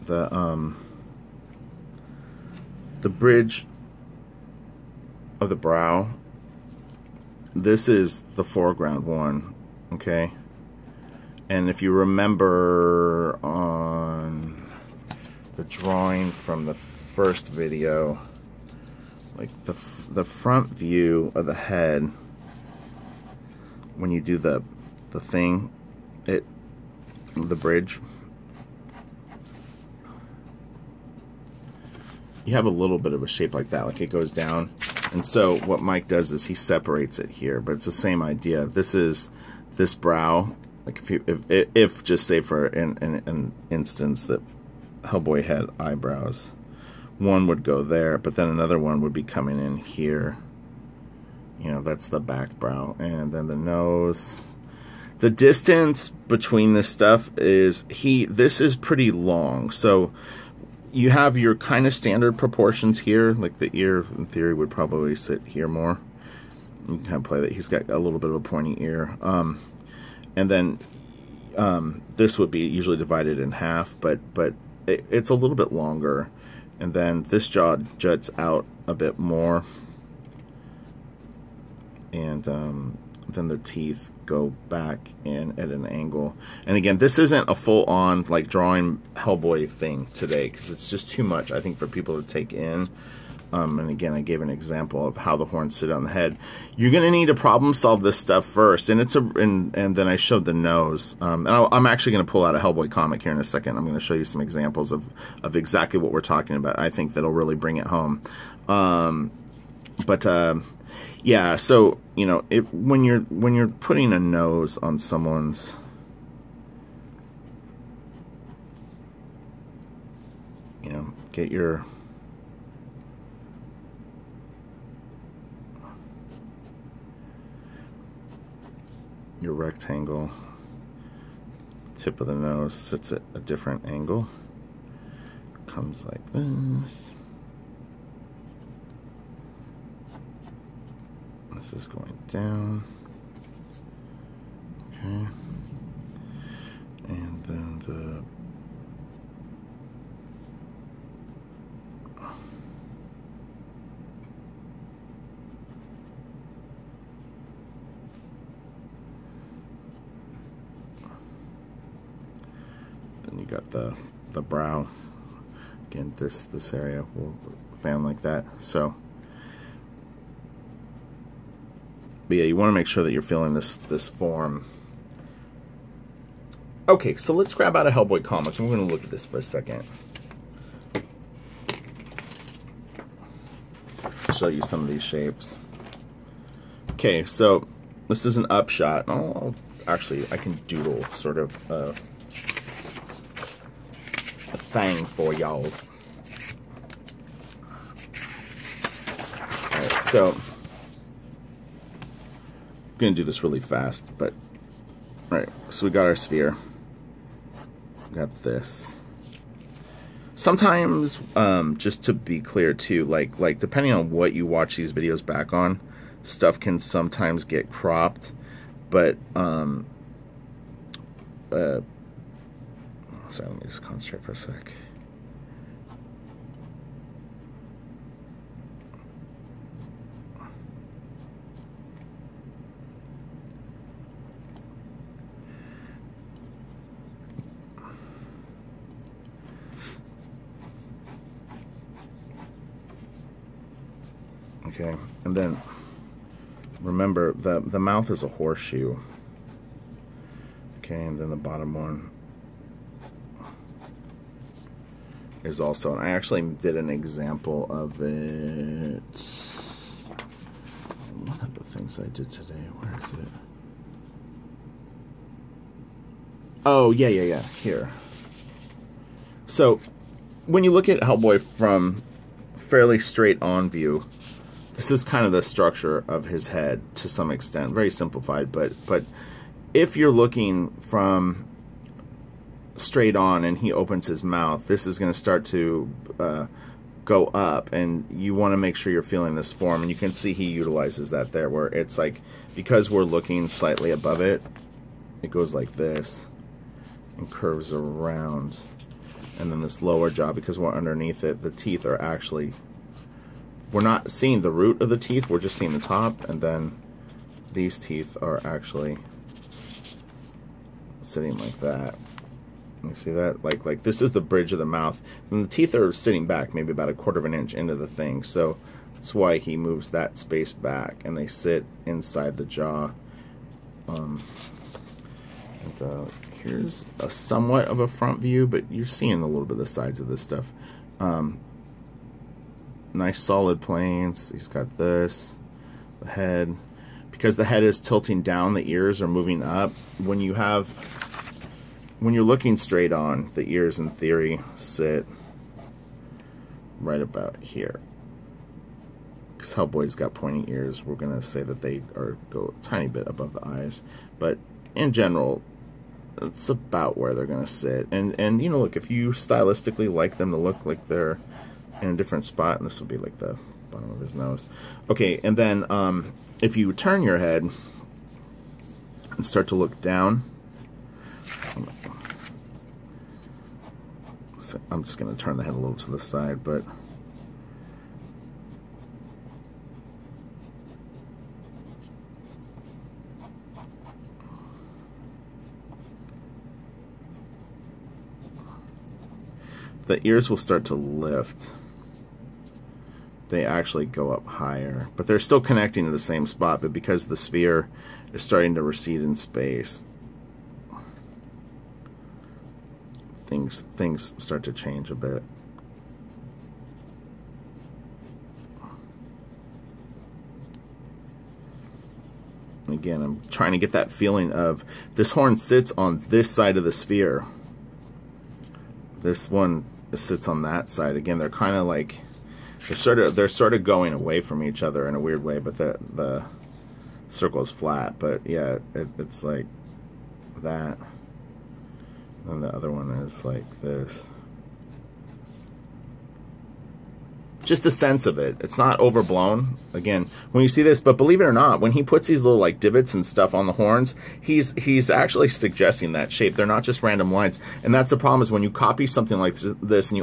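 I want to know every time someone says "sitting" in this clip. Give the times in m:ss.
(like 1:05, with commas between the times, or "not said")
5:11, 5:15.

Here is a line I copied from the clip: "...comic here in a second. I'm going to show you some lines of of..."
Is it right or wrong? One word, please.
wrong.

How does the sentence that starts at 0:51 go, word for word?
You know, that's the back brow.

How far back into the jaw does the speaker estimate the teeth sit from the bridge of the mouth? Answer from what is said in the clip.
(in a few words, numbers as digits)
a quarter of an inch.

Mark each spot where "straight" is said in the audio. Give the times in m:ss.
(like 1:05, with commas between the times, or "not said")
4:32, 4:42, 5:42.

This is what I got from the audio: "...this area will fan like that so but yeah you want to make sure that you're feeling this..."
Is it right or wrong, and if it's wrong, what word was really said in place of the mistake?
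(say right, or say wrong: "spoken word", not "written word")
right.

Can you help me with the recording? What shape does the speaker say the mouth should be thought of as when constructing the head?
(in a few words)
horseshoe.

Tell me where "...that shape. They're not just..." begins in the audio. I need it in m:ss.
7:25.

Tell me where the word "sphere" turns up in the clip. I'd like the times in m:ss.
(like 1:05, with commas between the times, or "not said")
3:26, 6:37, 6:56.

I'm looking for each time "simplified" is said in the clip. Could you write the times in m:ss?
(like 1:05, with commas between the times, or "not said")
4:37.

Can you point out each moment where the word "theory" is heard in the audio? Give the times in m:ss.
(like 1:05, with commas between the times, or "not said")
1:04, 5:43.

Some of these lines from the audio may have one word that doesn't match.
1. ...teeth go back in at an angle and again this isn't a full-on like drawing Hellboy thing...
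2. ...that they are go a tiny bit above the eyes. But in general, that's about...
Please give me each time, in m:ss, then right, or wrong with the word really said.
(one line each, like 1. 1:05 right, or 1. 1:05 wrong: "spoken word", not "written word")
1. 1:23 right
2. 5:51 right.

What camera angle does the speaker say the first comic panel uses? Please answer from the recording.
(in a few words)
an upshot.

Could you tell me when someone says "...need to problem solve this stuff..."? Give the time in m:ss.
1:37.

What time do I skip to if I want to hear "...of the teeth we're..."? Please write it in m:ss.
5:04.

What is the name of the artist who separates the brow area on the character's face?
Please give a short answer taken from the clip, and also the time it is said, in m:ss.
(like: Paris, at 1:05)
Mike, at 0:35.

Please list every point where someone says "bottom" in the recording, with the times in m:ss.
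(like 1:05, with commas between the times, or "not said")
4:11, 6:03.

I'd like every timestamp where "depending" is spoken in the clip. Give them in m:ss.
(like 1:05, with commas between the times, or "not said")
3:33.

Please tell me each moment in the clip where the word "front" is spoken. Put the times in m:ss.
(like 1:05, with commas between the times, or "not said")
0:20, 5:27.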